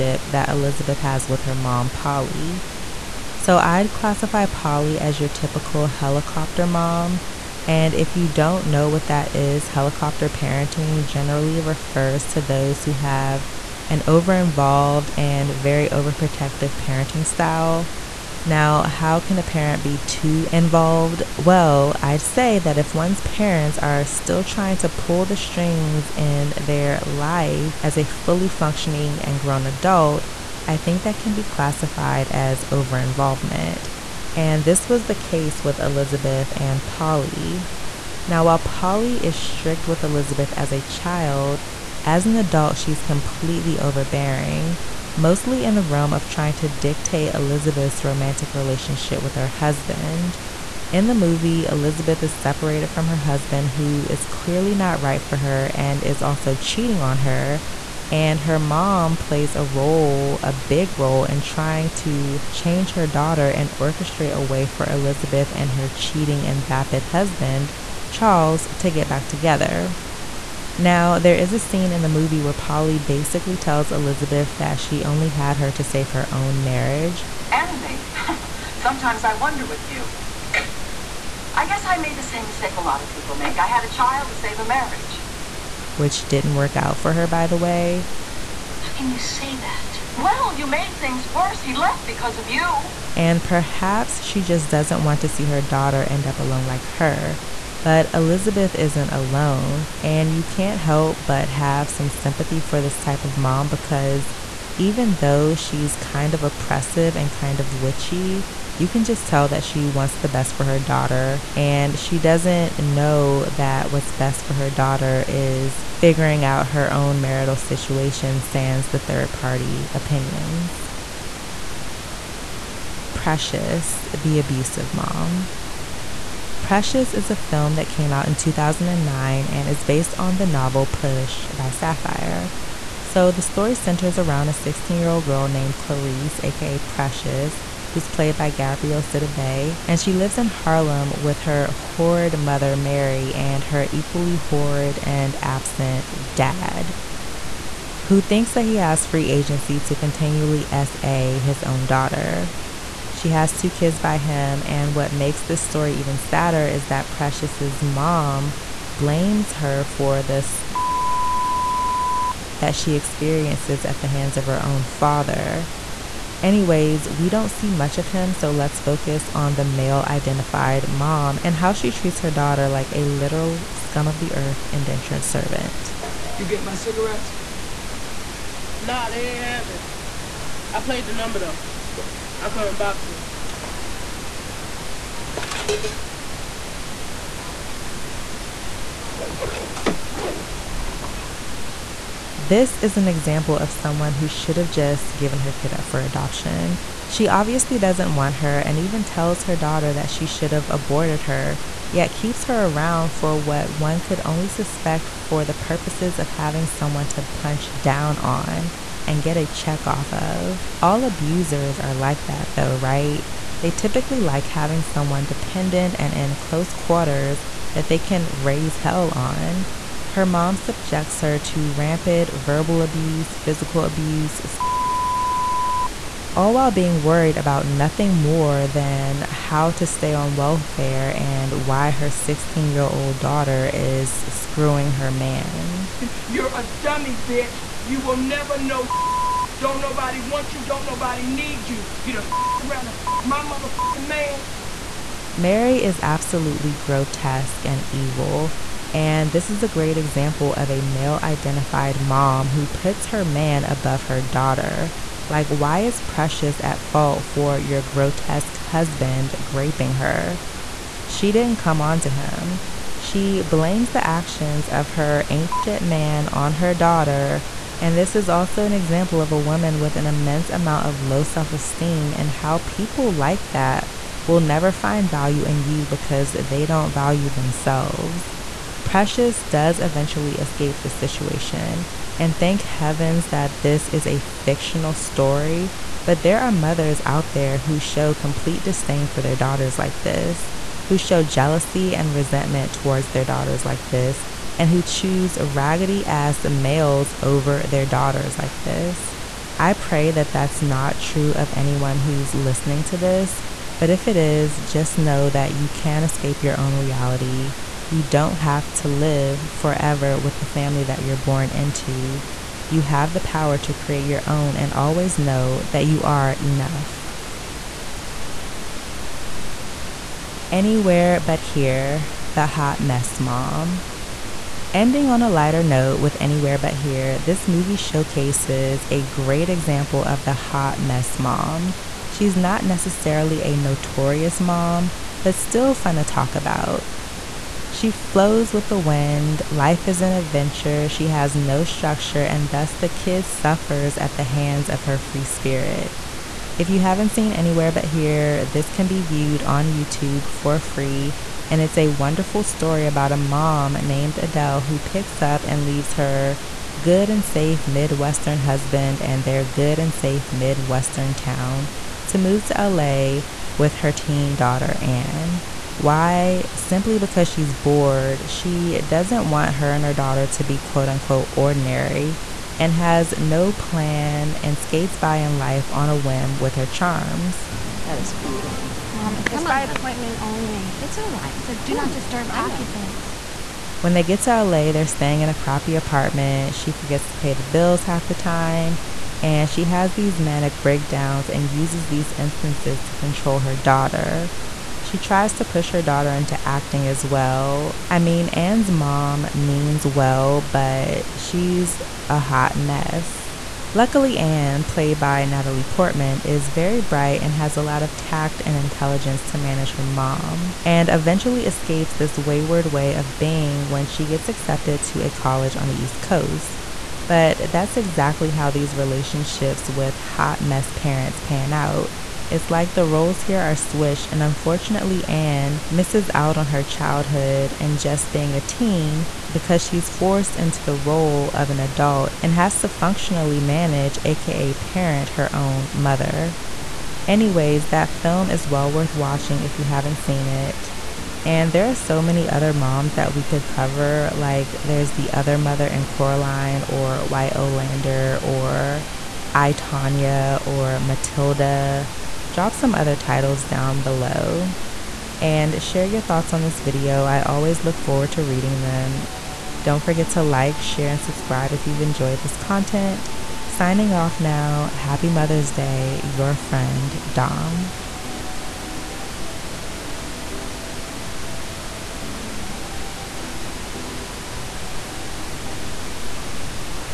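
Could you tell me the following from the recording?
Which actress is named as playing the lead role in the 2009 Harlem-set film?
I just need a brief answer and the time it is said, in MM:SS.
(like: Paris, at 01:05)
Gabrielle Sidibe, at 02:18.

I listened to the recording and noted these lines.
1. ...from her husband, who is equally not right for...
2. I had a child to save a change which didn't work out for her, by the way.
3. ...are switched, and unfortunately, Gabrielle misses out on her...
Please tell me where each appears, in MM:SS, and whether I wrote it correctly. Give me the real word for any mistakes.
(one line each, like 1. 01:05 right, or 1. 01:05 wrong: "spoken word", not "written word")
1. 00:52 wrong: "clearly", not "equally"
2. 01:23 wrong: "marriage", not "change"
3. 07:03 wrong: "Anne", not "Gabrielle".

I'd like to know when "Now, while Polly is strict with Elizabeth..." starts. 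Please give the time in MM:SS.
00:38.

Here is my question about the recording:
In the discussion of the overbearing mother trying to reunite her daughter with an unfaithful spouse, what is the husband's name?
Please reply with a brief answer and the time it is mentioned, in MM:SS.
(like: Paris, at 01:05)
Charles, at 01:08.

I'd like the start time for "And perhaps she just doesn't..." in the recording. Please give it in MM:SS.
01:33.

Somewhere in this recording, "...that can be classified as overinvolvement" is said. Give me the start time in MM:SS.
00:31.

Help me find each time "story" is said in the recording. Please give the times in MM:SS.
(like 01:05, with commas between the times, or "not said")
02:13, 02:35, 04:44, 05:52.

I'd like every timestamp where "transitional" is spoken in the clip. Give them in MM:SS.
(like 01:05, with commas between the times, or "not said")
not said.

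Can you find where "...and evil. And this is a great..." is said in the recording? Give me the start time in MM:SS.
04:07.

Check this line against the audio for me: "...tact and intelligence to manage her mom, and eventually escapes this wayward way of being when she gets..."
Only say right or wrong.
right.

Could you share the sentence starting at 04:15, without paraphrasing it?
Like, why is Precious at fault for your grotesque husband graping her?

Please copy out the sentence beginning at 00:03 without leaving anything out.
So, I'd classify Polly as your typical helicopter mom.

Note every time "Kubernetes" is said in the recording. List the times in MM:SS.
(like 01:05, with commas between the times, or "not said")
not said.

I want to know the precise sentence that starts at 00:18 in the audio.
Now, how can a parent be too involved?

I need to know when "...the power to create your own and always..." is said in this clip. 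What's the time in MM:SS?
05:13.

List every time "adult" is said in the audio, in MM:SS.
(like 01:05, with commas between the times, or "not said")
00:29, 00:42, 07:11.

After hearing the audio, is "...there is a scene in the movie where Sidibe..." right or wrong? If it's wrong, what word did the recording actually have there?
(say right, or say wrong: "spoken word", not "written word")
wrong: "Polly", not "Sidibe".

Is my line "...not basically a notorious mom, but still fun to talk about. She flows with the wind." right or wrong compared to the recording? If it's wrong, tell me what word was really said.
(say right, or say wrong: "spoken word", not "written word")
wrong: "necessarily", not "basically".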